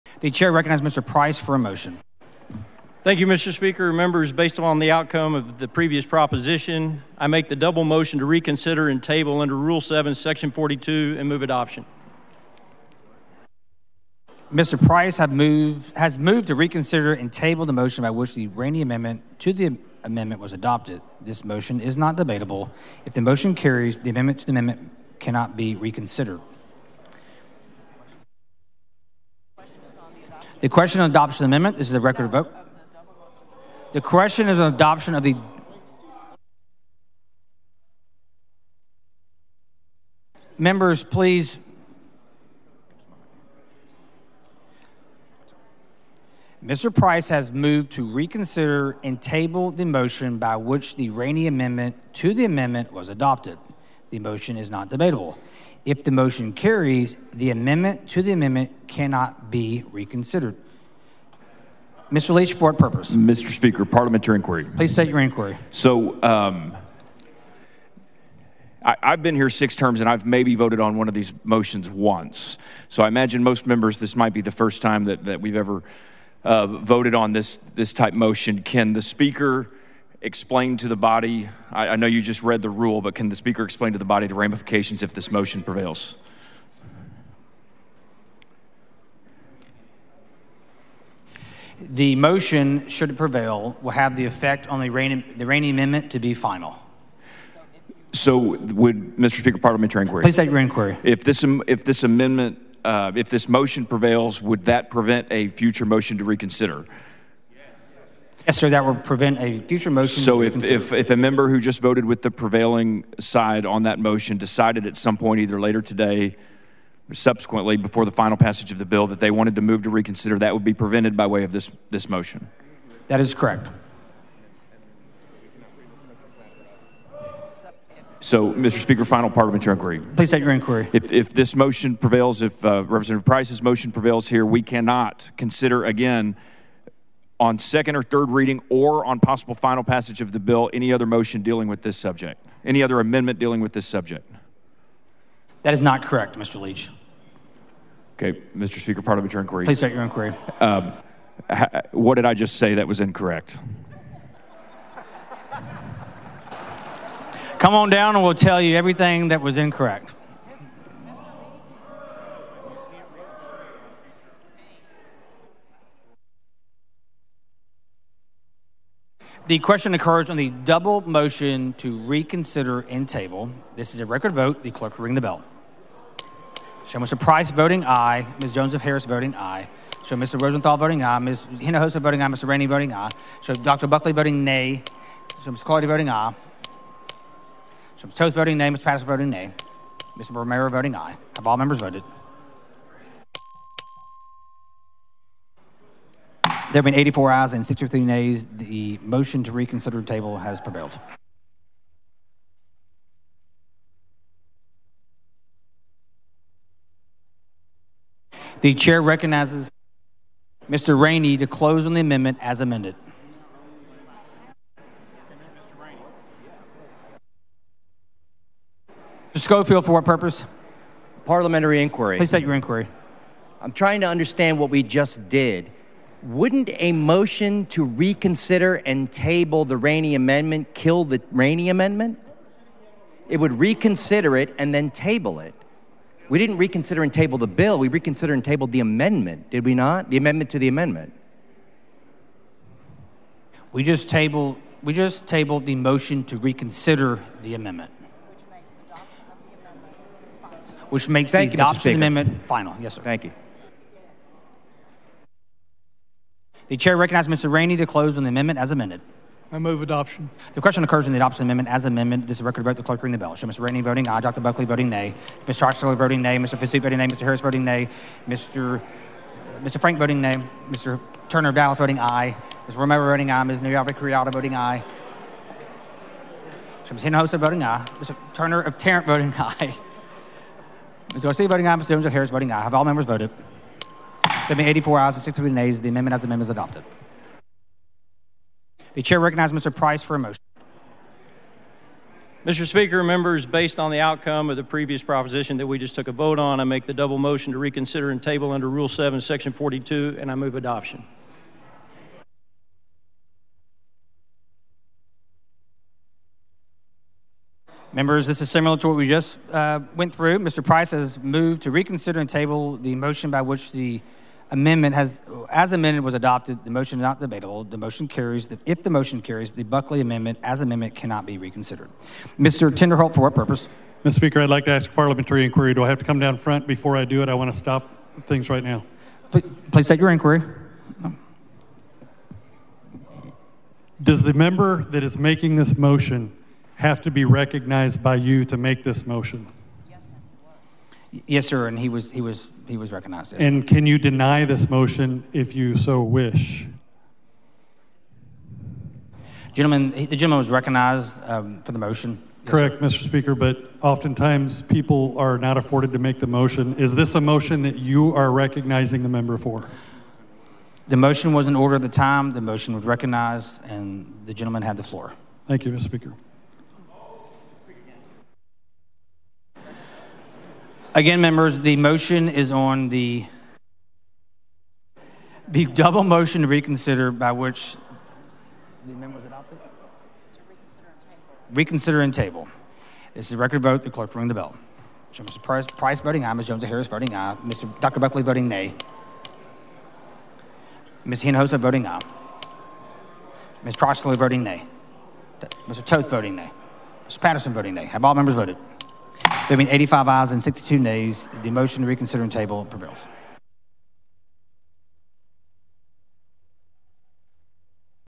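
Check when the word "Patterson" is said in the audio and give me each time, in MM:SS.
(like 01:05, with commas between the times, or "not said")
03:08, 06:37.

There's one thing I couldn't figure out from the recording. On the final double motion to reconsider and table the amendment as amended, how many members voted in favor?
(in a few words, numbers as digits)
85.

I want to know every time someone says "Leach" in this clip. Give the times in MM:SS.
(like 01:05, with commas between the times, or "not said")
01:02, 02:26.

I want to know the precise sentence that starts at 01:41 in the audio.
If this, if this amendment, uh, if this motion prevails, would that prevent a future motion to reconsider?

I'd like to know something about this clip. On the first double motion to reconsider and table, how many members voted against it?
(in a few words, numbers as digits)
63.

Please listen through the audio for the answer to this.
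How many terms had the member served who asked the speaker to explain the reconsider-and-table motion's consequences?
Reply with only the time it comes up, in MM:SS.
01:09.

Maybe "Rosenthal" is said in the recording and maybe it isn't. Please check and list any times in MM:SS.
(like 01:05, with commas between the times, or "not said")
03:00.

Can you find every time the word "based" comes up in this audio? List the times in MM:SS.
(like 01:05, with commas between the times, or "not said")
00:04, 04:53.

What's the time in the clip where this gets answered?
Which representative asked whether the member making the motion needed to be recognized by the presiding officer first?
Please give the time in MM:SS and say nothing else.
05:22.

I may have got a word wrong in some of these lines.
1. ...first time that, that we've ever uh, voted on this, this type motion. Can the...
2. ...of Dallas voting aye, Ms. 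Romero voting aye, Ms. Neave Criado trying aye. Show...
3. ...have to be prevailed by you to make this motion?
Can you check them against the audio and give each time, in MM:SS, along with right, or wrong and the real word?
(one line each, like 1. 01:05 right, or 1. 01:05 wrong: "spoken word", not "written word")
1. 01:14 right
2. 04:31 wrong: "voting", not "trying"
3. 05:36 wrong: "recognized", not "prevailed".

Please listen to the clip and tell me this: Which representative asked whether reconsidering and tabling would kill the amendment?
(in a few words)
Mr. Schofield.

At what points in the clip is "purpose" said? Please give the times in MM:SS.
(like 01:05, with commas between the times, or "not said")
01:02, 03:40, 05:23.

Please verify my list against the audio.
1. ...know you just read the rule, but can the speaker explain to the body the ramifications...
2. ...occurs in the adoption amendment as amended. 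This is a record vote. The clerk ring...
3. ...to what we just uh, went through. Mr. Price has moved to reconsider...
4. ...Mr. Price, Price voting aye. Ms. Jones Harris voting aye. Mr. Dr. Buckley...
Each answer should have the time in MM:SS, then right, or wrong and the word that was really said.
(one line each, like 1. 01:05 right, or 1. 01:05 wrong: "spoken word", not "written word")
1. 01:21 right
2. 04:20 right
3. 05:08 right
4. 06:25 right.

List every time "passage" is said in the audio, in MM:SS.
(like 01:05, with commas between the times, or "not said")
01:58, 02:19.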